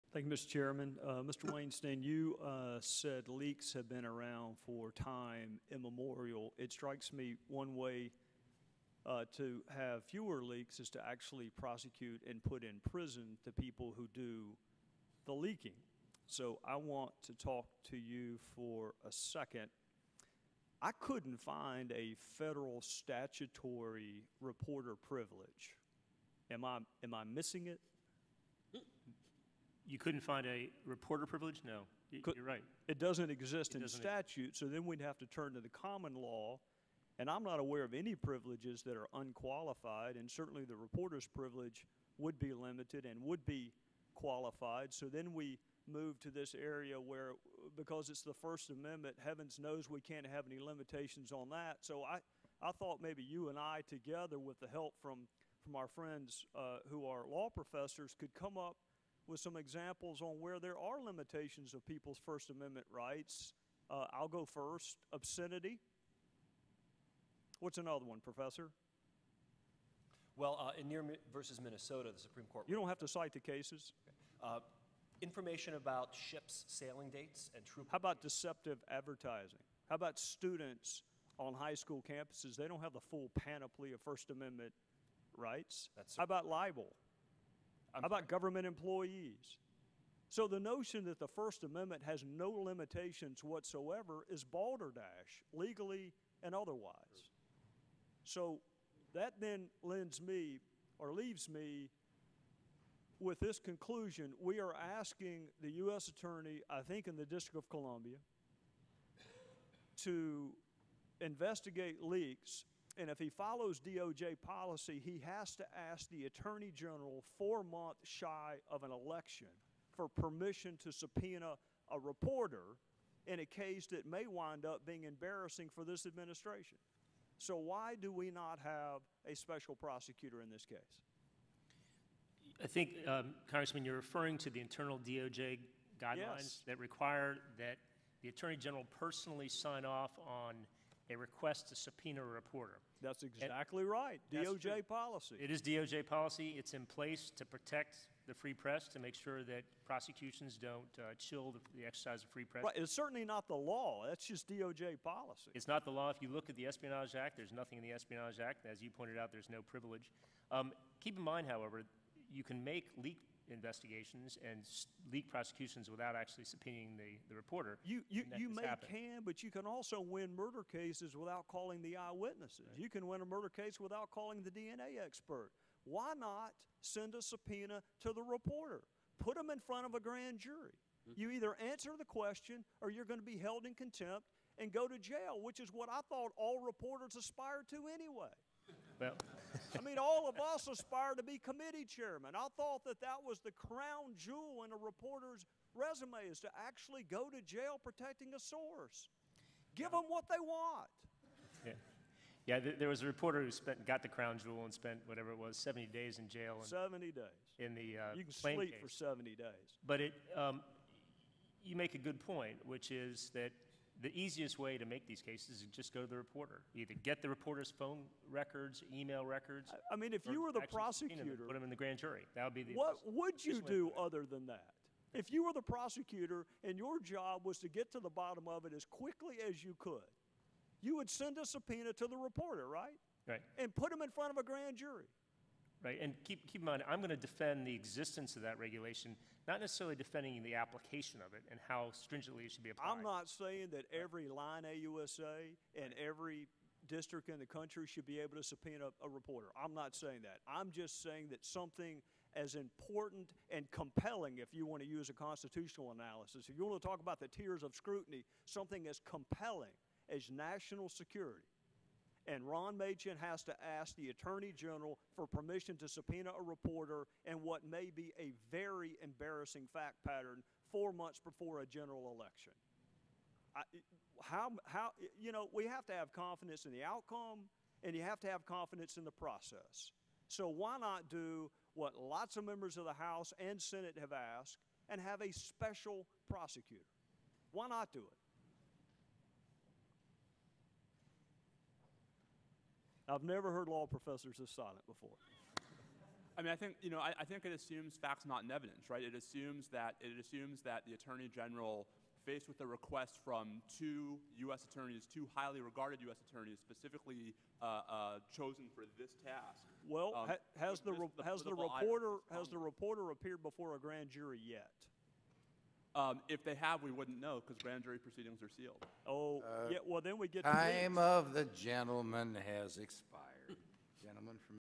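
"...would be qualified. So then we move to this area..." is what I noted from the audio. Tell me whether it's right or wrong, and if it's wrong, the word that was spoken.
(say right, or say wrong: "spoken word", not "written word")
right.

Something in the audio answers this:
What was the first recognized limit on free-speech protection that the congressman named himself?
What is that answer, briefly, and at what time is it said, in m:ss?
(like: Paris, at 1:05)
Obscenity, at 1:05.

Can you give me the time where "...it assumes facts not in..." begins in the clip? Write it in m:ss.
4:57.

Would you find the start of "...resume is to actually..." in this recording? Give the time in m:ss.
3:15.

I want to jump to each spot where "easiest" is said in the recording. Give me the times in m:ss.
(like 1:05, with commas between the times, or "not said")
3:34.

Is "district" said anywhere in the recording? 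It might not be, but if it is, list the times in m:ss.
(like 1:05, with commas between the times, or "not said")
1:47, 4:06.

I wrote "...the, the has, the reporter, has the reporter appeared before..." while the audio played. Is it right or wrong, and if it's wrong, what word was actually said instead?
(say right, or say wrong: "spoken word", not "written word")
right.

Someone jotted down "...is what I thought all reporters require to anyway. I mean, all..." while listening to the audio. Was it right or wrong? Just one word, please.
wrong.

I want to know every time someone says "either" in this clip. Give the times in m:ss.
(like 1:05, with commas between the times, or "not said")
3:01, 3:36.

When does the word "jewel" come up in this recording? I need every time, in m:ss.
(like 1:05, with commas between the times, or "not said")
3:14, 3:24.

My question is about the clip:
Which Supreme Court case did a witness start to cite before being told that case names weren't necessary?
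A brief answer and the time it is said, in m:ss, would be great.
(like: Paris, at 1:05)
Near versus Minnesota, at 1:10.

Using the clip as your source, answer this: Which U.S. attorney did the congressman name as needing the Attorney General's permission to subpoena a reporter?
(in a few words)
Ron Machen.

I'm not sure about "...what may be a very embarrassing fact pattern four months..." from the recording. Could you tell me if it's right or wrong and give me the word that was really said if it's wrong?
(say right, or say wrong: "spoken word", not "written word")
right.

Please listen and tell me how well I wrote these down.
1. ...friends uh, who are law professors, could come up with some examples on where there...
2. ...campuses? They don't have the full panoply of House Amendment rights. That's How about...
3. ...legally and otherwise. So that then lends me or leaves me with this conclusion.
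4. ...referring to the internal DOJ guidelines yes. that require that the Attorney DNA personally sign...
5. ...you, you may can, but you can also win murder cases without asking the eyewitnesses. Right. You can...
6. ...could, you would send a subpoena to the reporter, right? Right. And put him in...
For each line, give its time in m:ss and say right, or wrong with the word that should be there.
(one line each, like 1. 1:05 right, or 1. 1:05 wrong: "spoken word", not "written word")
1. 0:55 right
2. 1:22 wrong: "First", not "House"
3. 1:35 right
4. 2:13 wrong: "General", not "DNA"
5. 2:48 wrong: "calling", not "asking"
6. 3:49 right.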